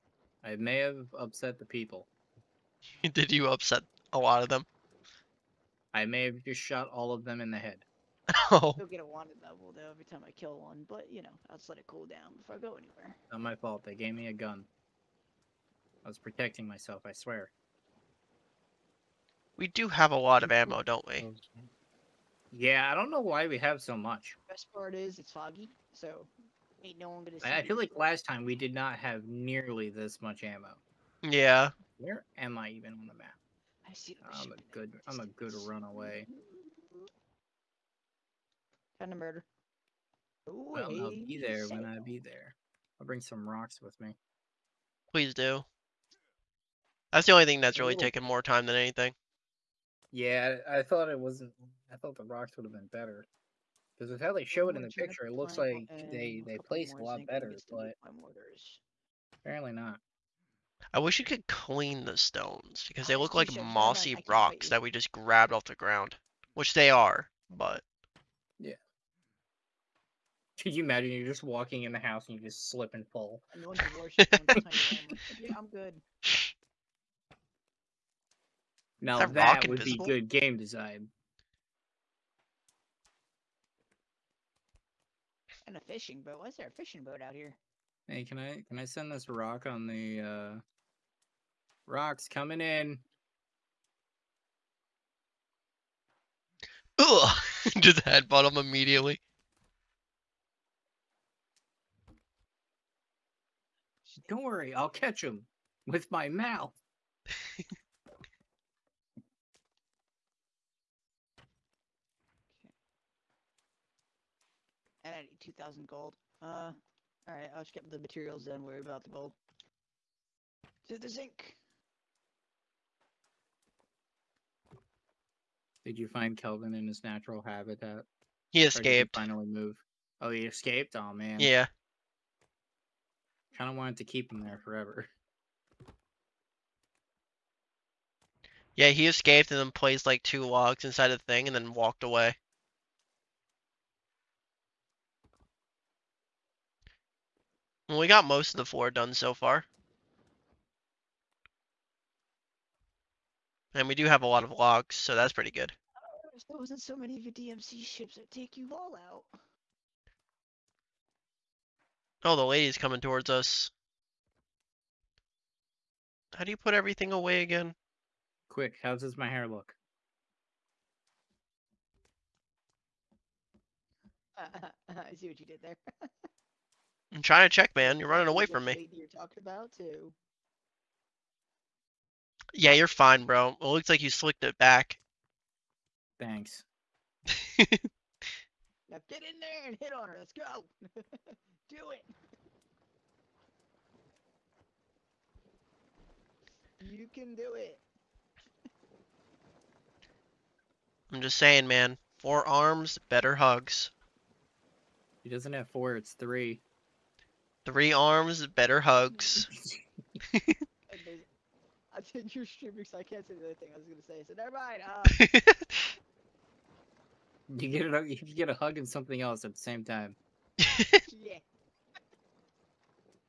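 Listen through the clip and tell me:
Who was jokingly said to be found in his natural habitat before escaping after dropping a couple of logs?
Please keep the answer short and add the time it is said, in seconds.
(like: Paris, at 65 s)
Kelvin, at 126 s.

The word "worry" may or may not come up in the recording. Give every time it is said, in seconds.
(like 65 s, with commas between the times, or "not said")
104 s, 118 s.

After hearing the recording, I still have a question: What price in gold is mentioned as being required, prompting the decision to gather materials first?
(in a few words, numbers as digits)
2,000 gold.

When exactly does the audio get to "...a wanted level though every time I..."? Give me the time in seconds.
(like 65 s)
8 s.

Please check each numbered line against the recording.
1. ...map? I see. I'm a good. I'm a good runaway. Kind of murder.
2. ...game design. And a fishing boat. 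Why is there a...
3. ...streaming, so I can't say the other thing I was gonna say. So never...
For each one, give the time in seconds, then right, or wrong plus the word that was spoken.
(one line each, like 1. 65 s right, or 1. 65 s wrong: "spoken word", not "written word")
1. 33 s right
2. 80 s right
3. 212 s right.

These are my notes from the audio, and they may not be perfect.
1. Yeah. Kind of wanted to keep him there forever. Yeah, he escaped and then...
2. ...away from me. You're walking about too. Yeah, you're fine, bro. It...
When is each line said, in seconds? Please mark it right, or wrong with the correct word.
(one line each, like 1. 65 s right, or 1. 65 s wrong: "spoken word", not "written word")
1. 131 s right
2. 178 s wrong: "talking", not "walking".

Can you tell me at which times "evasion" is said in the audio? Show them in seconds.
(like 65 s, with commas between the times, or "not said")
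not said.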